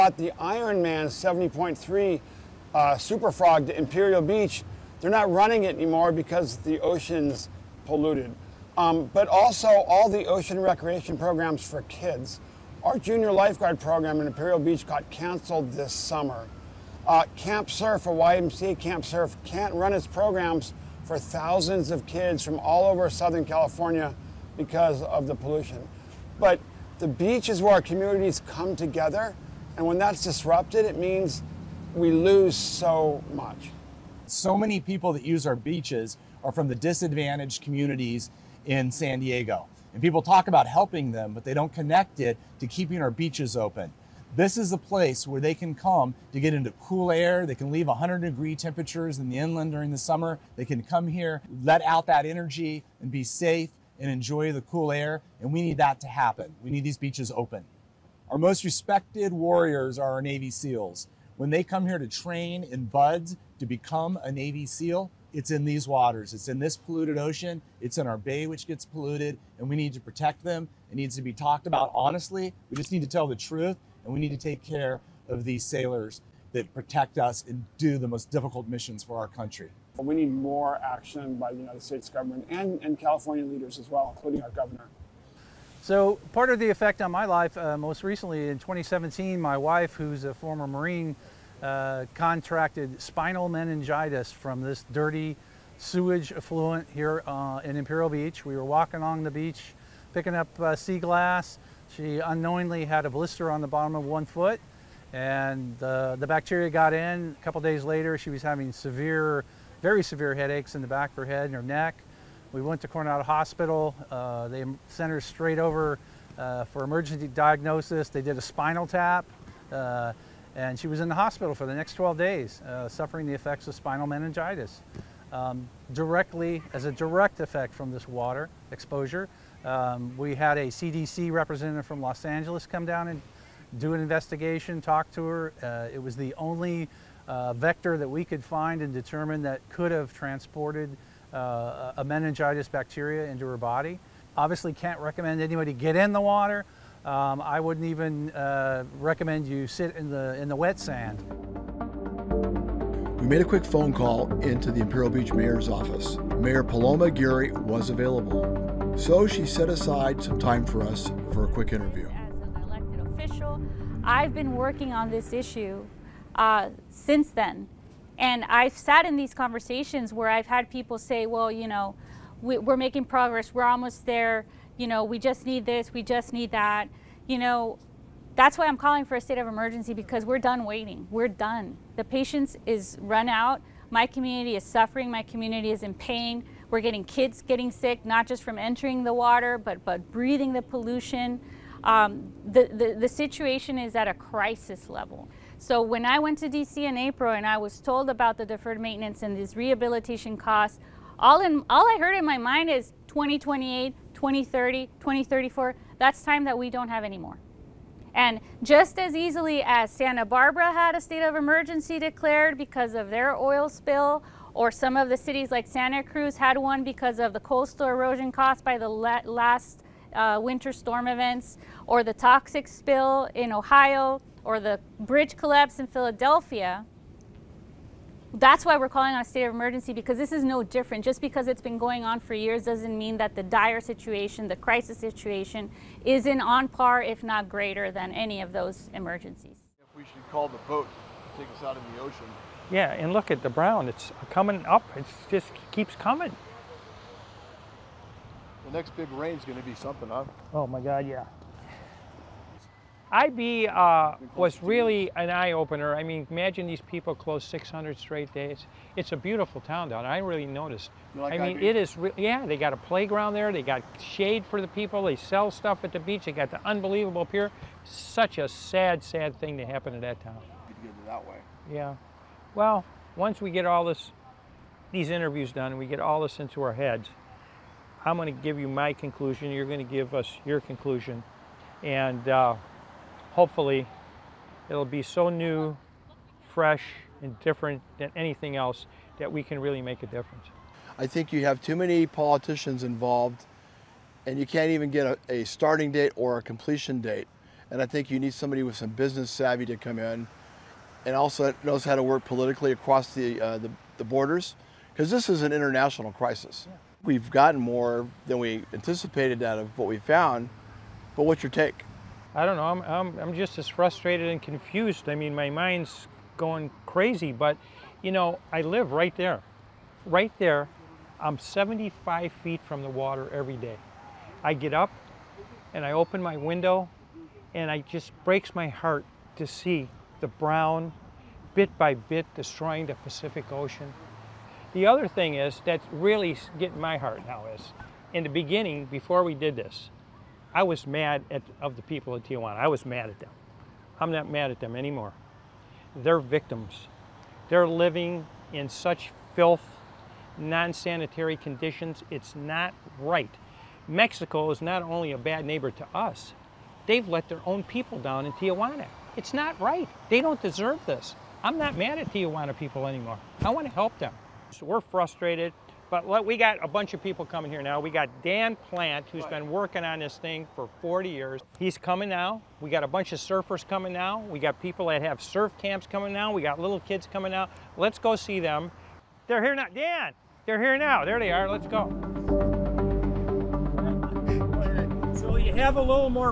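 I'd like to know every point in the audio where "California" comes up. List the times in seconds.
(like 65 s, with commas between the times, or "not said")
23 s, 82 s.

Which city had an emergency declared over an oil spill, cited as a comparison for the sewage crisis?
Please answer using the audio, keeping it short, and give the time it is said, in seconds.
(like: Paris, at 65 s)
Santa Barbara, at 209 s.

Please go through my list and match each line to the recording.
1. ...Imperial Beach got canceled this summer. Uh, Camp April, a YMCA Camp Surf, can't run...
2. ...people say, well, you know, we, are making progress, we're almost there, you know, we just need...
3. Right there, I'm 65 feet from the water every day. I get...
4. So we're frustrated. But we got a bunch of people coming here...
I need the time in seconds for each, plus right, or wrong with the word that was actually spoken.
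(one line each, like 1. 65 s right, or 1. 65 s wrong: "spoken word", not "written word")
1. 14 s wrong: "Surf", not "April"
2. 170 s right
3. 320 s wrong: "75", not "65"
4. 364 s right.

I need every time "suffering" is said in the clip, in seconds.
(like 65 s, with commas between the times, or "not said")
122 s, 184 s.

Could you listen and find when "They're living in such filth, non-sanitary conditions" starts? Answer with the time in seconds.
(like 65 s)
347 s.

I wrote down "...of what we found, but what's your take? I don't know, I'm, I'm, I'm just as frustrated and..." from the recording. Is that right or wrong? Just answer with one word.
right.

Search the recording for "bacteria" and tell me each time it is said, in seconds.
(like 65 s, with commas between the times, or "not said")
106 s, 142 s.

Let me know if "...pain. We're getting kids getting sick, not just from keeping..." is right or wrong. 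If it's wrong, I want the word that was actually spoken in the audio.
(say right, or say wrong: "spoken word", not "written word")
wrong: "entering", not "keeping".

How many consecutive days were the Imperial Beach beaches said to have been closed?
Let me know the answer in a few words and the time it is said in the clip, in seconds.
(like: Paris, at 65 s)
600, at 257 s.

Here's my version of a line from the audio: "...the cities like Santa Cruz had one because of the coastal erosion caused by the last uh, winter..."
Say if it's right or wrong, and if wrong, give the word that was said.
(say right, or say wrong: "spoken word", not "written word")
right.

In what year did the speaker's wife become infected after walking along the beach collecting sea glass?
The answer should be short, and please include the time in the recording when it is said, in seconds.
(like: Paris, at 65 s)
2017, at 88 s.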